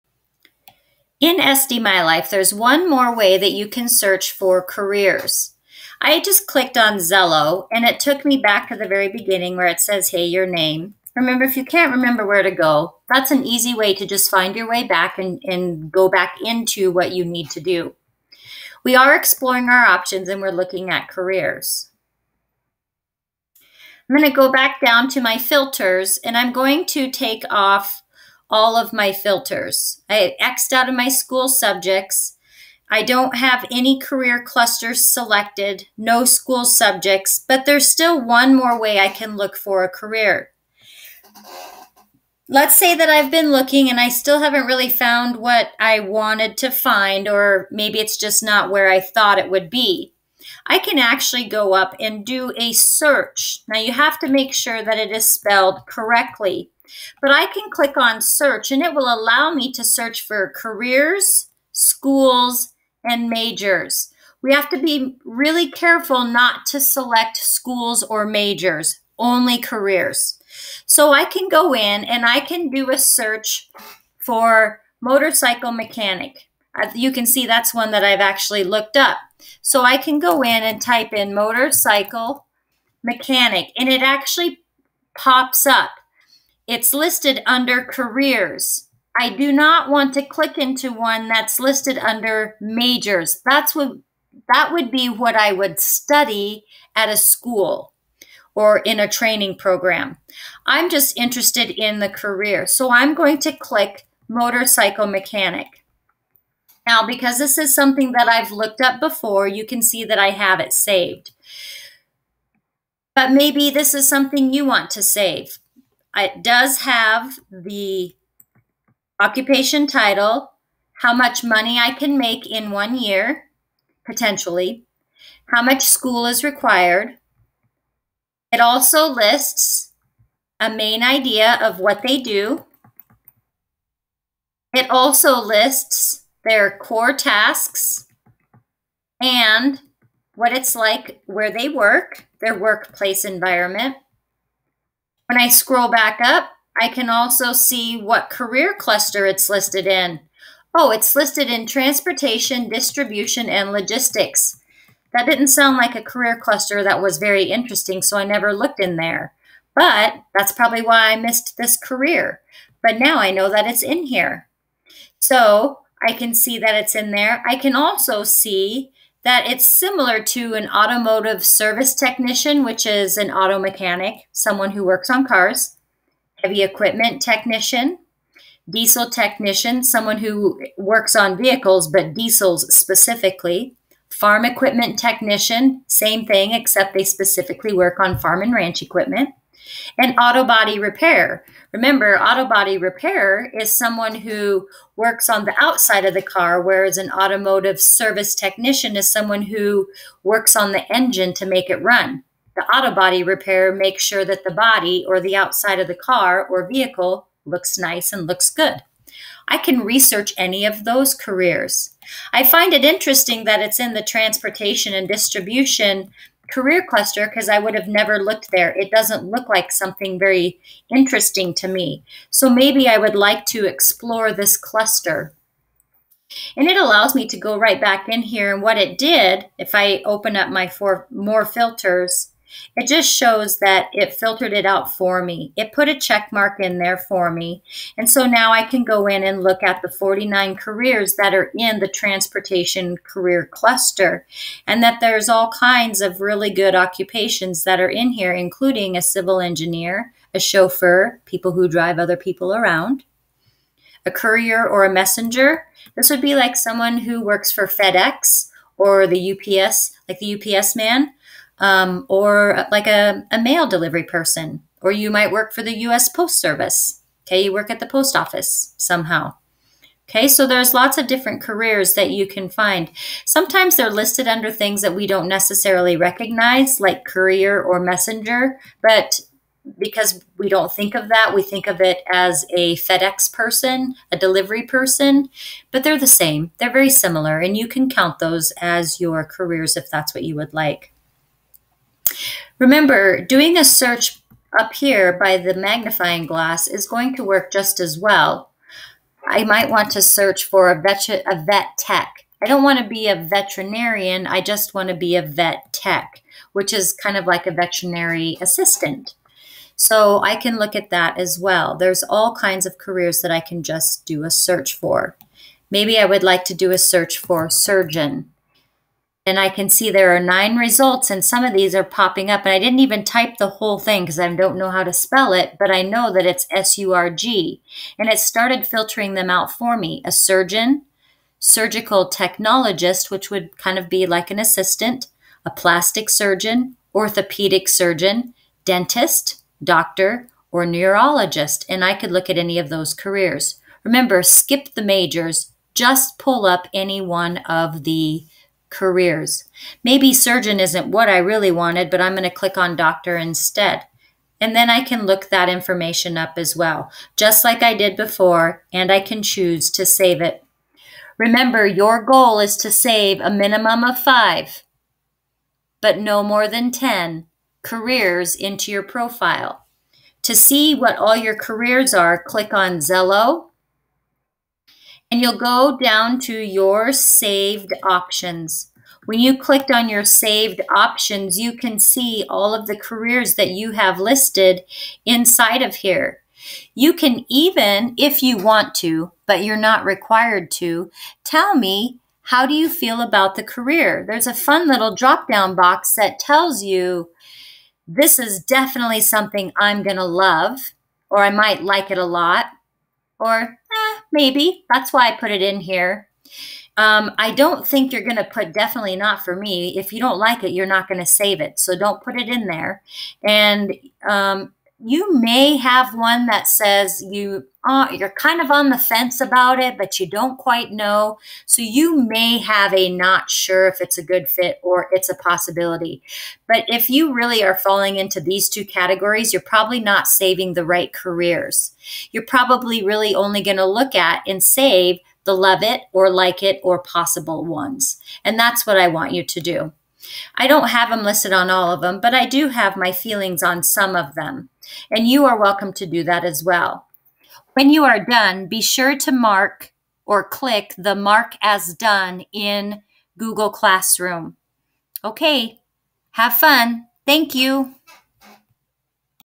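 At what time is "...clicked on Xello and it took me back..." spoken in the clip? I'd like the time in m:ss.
0:06.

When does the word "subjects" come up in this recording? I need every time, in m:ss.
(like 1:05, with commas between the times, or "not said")
0:31, 0:36.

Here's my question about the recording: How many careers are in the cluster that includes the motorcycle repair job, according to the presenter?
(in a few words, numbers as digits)
49.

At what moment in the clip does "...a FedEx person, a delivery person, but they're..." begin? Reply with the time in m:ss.
4:42.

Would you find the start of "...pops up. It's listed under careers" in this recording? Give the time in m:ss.
1:25.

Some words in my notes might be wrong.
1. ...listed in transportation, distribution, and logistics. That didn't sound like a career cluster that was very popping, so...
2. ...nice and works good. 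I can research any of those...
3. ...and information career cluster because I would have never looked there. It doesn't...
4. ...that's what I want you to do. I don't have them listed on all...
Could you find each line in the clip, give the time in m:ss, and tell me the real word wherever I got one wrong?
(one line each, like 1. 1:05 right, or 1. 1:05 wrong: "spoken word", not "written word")
1. 2:31 wrong: "interesting", not "popping"
2. 3:27 wrong: "looks", not "works"
3. 3:34 wrong: "distribution", not "information"
4. 7:18 right.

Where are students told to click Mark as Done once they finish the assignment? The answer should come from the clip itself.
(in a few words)
Google Classroom.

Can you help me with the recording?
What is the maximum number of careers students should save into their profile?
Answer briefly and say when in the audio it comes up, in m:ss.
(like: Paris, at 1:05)
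10, at 6:06.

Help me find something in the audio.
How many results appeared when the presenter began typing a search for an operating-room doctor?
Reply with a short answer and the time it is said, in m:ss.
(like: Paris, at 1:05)
9, at 5:20.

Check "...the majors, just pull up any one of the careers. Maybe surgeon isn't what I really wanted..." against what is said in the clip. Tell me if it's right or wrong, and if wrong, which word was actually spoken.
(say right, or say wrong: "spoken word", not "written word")
right.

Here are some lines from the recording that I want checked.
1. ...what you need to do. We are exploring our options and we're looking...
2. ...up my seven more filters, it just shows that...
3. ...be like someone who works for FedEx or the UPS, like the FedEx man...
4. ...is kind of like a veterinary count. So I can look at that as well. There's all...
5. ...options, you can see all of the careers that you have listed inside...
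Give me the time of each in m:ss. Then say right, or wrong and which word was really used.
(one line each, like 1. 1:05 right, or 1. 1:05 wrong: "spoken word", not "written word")
1. 0:16 right
2. 3:50 wrong: "four", not "seven"
3. 4:16 wrong: "UPS", not "FedEx"
4. 5:06 wrong: "assistant", not "count"
5. 6:20 right.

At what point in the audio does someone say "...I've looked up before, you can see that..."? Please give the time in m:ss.
1:48.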